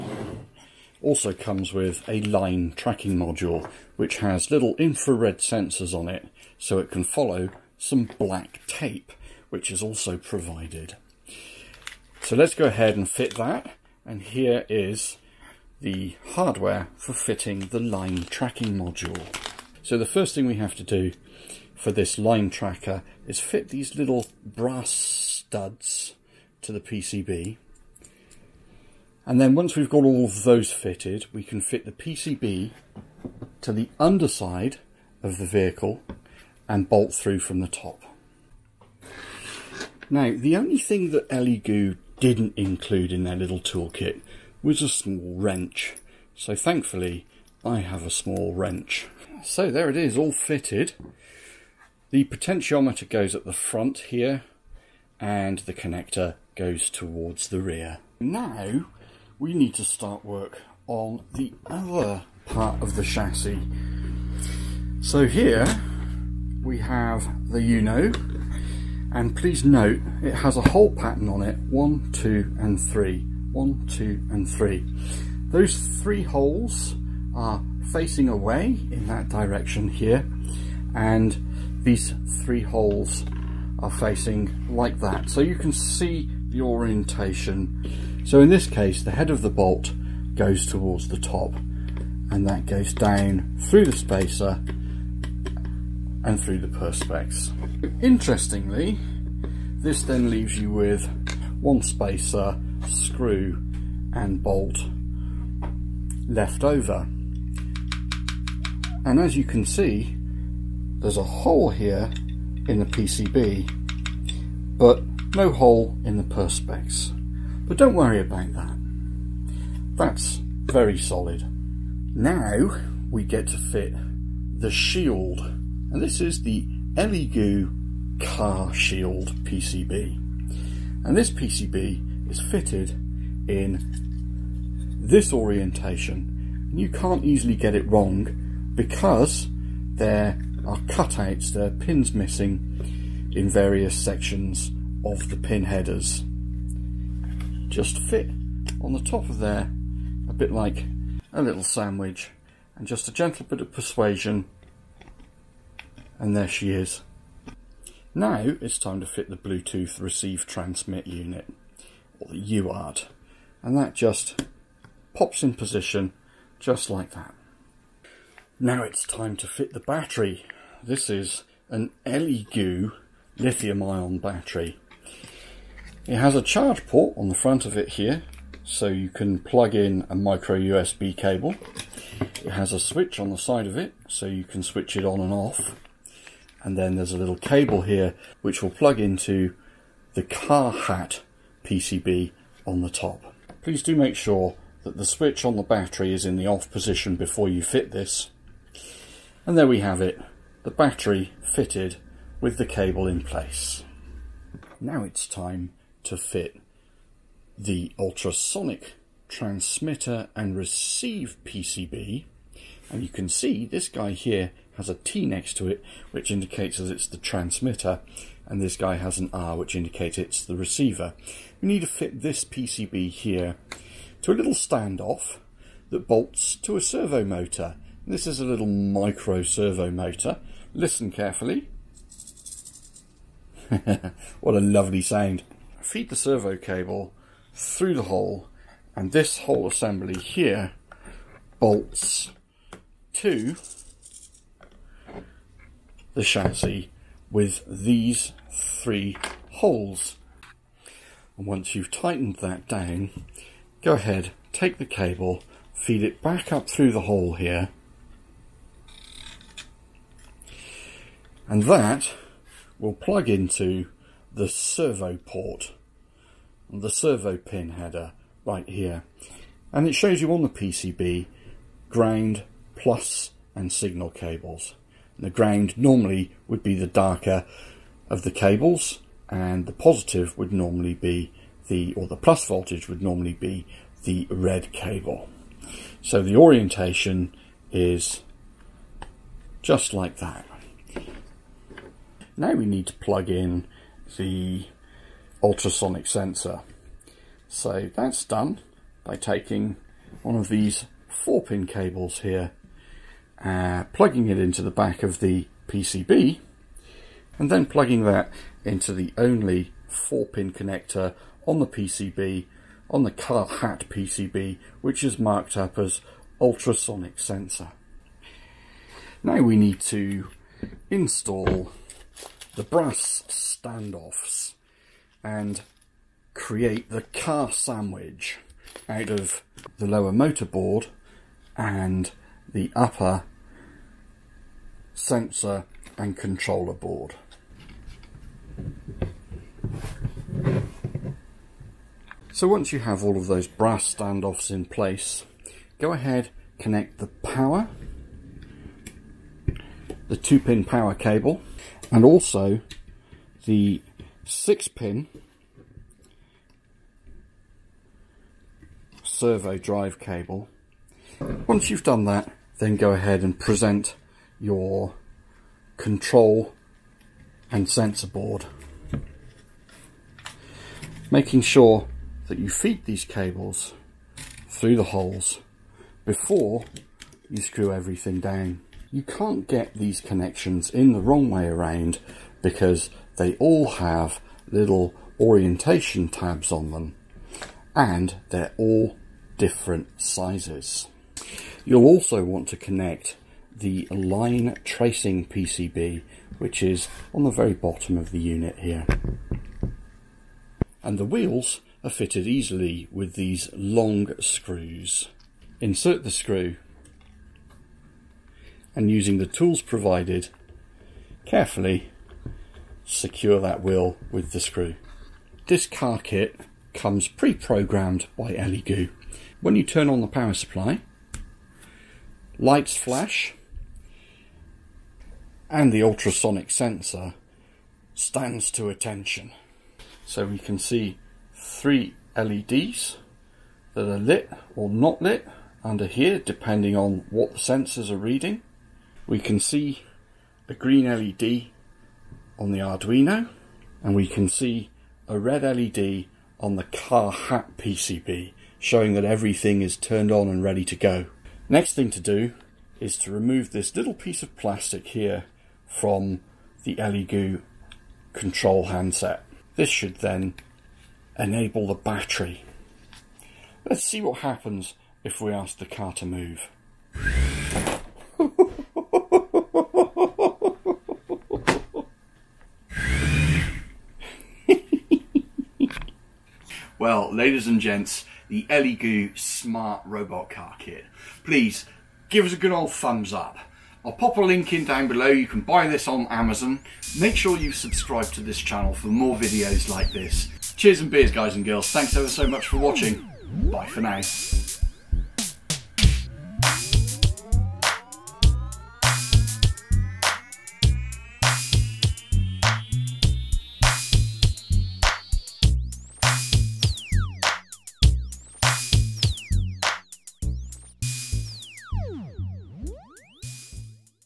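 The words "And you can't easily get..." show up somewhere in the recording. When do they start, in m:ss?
2:16.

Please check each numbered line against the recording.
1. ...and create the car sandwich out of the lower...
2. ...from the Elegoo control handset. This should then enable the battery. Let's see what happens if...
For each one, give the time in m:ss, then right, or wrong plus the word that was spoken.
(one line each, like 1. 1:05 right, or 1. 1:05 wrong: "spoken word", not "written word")
1. 5:25 right
2. 7:35 right.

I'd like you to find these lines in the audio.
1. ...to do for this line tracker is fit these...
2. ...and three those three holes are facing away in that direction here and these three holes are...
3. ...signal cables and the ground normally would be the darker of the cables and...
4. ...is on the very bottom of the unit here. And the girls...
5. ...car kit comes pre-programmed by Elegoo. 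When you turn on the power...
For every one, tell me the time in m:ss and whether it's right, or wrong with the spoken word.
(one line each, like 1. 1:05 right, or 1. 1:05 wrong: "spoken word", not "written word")
1. 0:20 right
2. 1:14 right
3. 4:33 right
4. 6:36 wrong: "wheels", not "girls"
5. 6:55 right.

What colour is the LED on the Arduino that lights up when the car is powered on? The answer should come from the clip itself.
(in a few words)
Green.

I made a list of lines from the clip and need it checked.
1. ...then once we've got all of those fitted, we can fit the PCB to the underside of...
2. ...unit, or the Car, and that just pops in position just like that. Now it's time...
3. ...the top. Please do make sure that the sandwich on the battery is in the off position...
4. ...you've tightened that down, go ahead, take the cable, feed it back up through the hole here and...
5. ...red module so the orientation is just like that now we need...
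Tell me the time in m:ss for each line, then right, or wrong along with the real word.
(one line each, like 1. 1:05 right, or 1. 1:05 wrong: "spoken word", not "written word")
1. 0:29 right
2. 2:41 wrong: "UART", not "Car"
3. 3:12 wrong: "switch", not "sandwich"
4. 4:11 right
5. 4:44 wrong: "cable", not "module".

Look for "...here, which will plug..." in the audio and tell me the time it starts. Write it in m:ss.
3:07.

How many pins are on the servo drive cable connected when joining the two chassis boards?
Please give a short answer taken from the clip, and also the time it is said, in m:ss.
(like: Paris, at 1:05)
6, at 5:54.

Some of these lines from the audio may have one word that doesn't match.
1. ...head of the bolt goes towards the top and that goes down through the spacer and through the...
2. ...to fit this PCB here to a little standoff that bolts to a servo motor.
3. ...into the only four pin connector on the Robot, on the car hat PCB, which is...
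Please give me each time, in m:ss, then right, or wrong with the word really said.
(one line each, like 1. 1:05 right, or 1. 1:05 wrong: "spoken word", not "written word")
1. 1:29 right
2. 3:41 right
3. 5:08 wrong: "PCB", not "Robot".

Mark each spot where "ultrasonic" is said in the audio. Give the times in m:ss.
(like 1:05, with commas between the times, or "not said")
3:27, 4:55, 5:16, 7:05.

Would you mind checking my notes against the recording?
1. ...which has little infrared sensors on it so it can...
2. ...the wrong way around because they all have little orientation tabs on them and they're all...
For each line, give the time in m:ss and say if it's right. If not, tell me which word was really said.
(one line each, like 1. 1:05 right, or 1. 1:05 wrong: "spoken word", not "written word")
1. 0:03 right
2. 6:20 right.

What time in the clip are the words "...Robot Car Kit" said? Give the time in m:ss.
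7:59.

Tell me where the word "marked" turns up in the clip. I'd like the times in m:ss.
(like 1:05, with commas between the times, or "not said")
5:15.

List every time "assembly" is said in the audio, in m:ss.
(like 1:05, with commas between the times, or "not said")
3:59.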